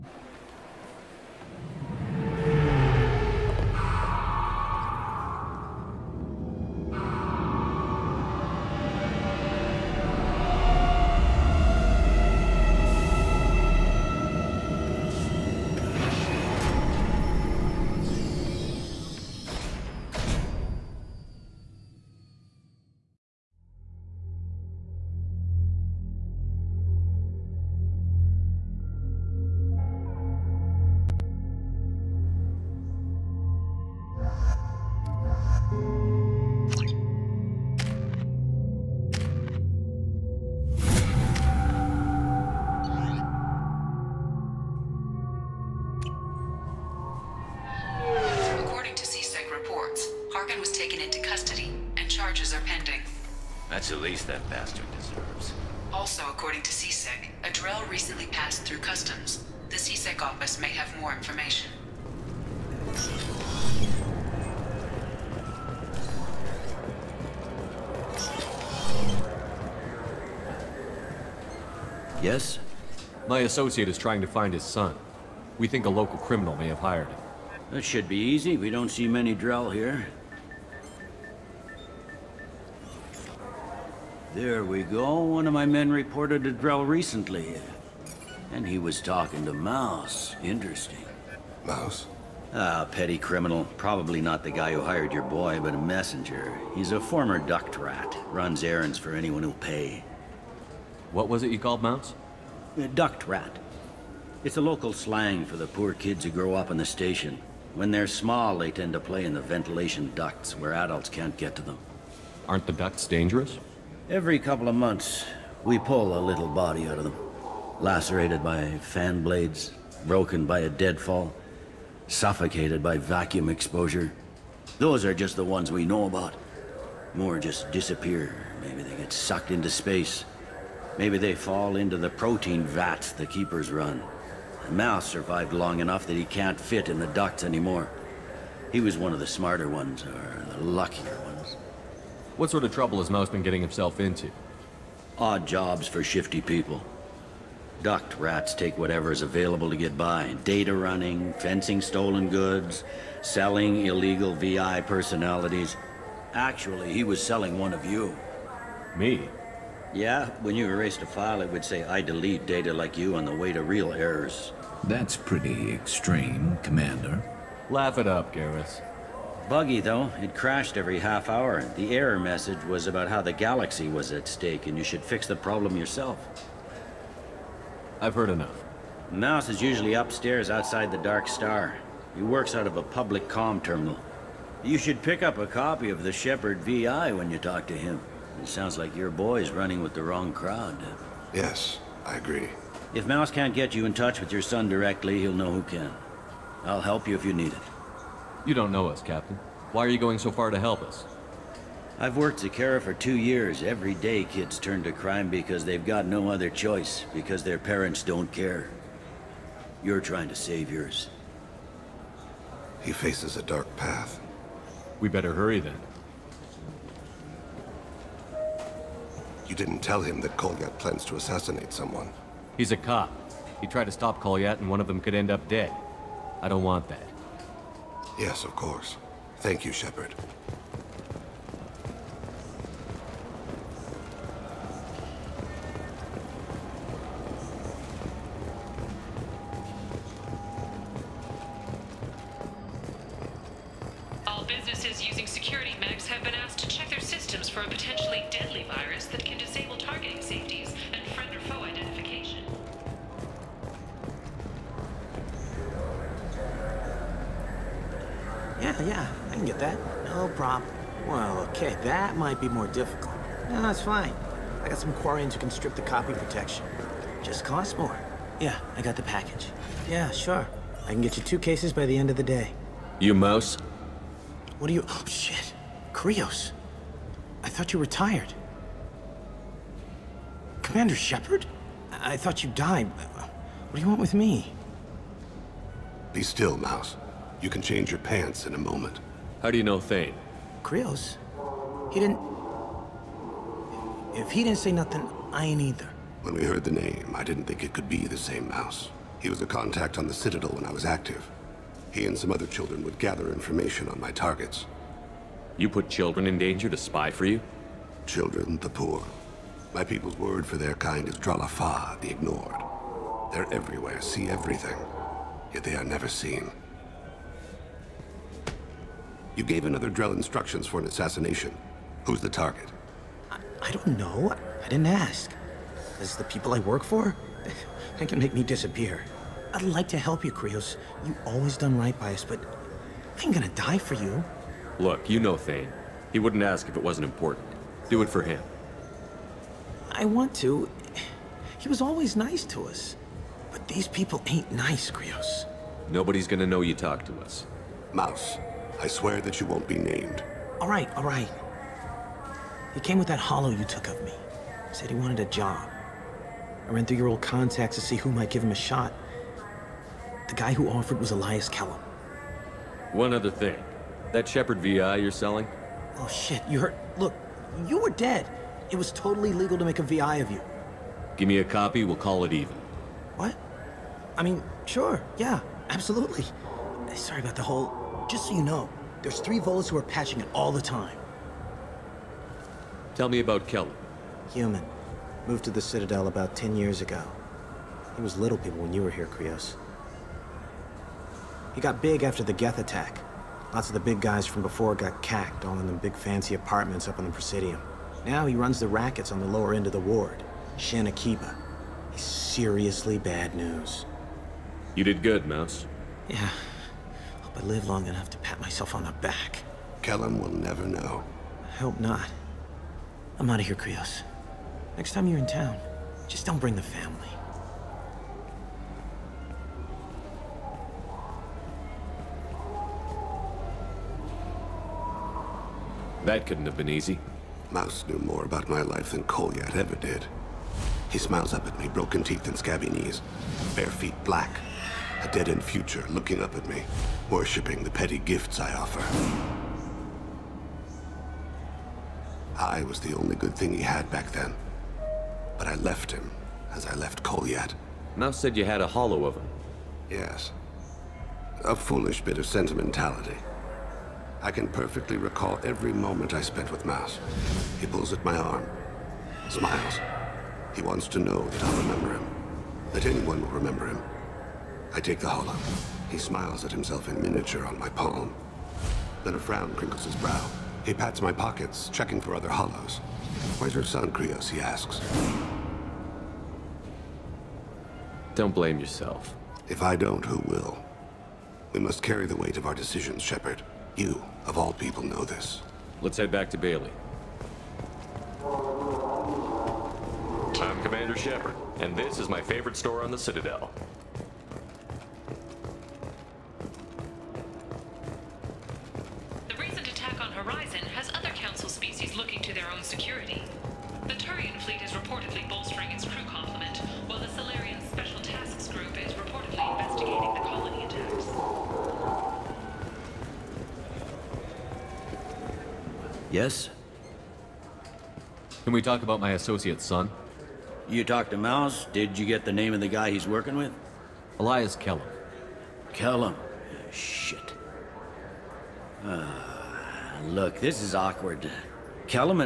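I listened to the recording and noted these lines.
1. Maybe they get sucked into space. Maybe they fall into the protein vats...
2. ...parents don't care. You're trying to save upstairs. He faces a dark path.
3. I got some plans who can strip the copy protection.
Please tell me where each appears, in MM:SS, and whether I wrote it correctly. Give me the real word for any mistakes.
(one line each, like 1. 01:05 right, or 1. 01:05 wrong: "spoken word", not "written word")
1. 02:08 right
2. 03:27 wrong: "yours", not "upstairs"
3. 04:24 wrong: "quarians", not "plans".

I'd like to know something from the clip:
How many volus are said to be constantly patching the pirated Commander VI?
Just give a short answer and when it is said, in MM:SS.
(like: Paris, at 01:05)
3, at 06:19.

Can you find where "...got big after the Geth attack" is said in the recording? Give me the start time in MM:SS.
06:31.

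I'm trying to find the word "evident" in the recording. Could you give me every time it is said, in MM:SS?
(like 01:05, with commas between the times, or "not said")
not said.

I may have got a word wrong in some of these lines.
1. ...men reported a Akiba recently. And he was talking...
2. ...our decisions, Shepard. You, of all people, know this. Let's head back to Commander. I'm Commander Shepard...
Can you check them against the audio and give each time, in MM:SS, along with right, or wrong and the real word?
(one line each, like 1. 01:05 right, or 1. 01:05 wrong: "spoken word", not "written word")
1. 01:25 wrong: "Drell", not "Akiba"
2. 08:02 wrong: "Bailey", not "Commander".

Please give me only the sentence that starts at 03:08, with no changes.
It sounds like your boy's running with the wrong crowd.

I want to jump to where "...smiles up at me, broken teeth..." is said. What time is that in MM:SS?
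07:10.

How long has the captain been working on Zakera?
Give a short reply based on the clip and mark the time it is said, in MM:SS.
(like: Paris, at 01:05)
2 years, at 03:22.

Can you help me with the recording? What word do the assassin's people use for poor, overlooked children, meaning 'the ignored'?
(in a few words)
Dralafa.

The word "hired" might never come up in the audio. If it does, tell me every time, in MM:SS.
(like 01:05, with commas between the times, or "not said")
01:16, 01:34.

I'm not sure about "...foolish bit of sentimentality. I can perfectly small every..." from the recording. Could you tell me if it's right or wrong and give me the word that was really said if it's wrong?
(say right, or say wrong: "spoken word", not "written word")
wrong: "recall", not "small".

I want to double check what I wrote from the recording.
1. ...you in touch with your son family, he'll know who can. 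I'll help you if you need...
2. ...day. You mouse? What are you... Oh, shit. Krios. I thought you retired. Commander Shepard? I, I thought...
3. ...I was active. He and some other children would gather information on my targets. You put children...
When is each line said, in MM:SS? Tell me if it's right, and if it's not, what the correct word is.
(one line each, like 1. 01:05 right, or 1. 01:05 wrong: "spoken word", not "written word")
1. 03:13 wrong: "directly", not "family"
2. 04:32 right
3. 05:00 right.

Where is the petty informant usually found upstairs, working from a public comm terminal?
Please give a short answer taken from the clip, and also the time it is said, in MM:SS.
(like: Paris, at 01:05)
Outside the Dark Star, at 03:00.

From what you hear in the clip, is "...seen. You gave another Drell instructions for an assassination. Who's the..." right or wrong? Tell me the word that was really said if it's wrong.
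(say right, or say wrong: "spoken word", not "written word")
right.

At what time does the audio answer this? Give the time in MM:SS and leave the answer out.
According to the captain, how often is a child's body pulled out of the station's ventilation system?
01:54.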